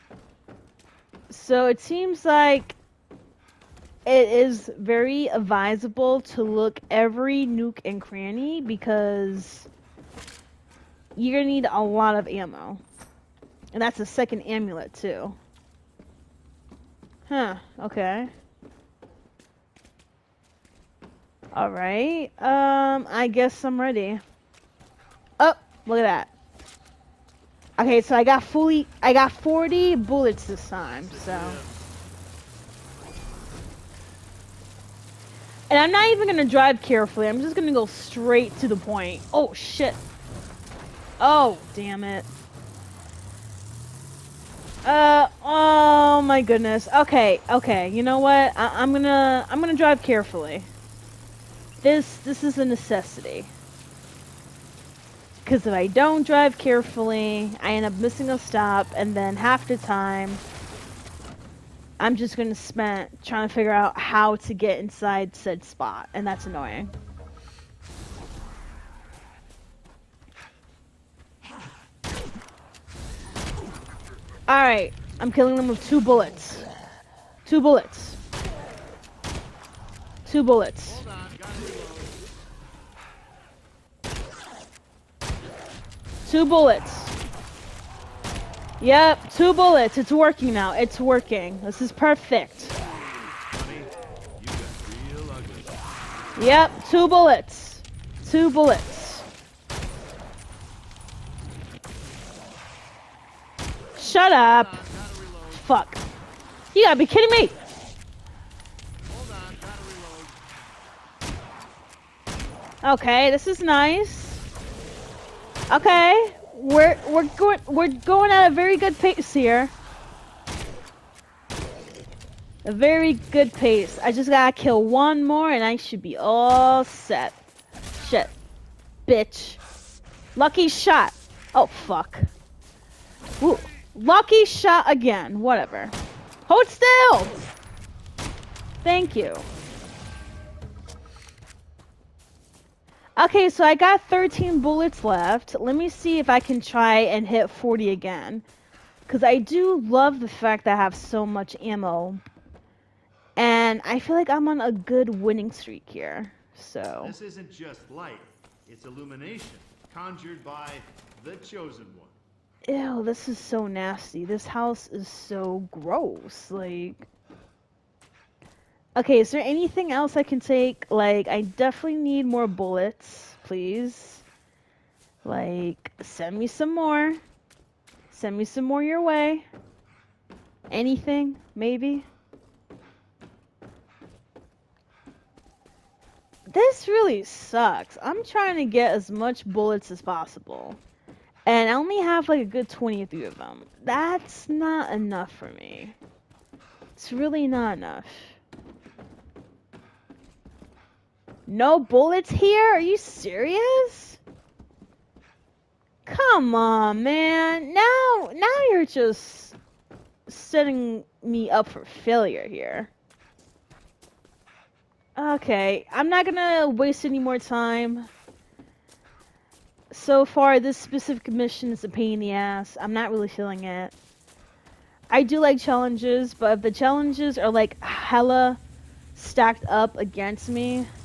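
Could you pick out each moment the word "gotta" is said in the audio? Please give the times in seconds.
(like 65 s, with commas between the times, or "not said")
106 s, 124 s.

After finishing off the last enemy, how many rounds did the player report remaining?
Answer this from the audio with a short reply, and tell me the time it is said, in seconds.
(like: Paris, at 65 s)
13, at 144 s.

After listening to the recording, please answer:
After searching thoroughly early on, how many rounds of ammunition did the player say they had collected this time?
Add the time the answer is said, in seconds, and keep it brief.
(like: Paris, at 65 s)
40, at 29 s.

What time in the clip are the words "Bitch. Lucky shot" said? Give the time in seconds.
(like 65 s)
129 s.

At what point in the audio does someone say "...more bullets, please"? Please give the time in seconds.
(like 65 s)
172 s.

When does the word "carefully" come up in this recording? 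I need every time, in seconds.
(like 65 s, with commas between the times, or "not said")
36 s, 50 s, 56 s.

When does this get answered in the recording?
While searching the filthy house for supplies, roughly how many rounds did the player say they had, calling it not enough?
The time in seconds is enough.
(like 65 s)
192 s.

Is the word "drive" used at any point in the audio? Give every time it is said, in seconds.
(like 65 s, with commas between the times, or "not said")
36 s, 49 s, 56 s.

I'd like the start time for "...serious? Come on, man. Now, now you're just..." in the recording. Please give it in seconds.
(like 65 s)
202 s.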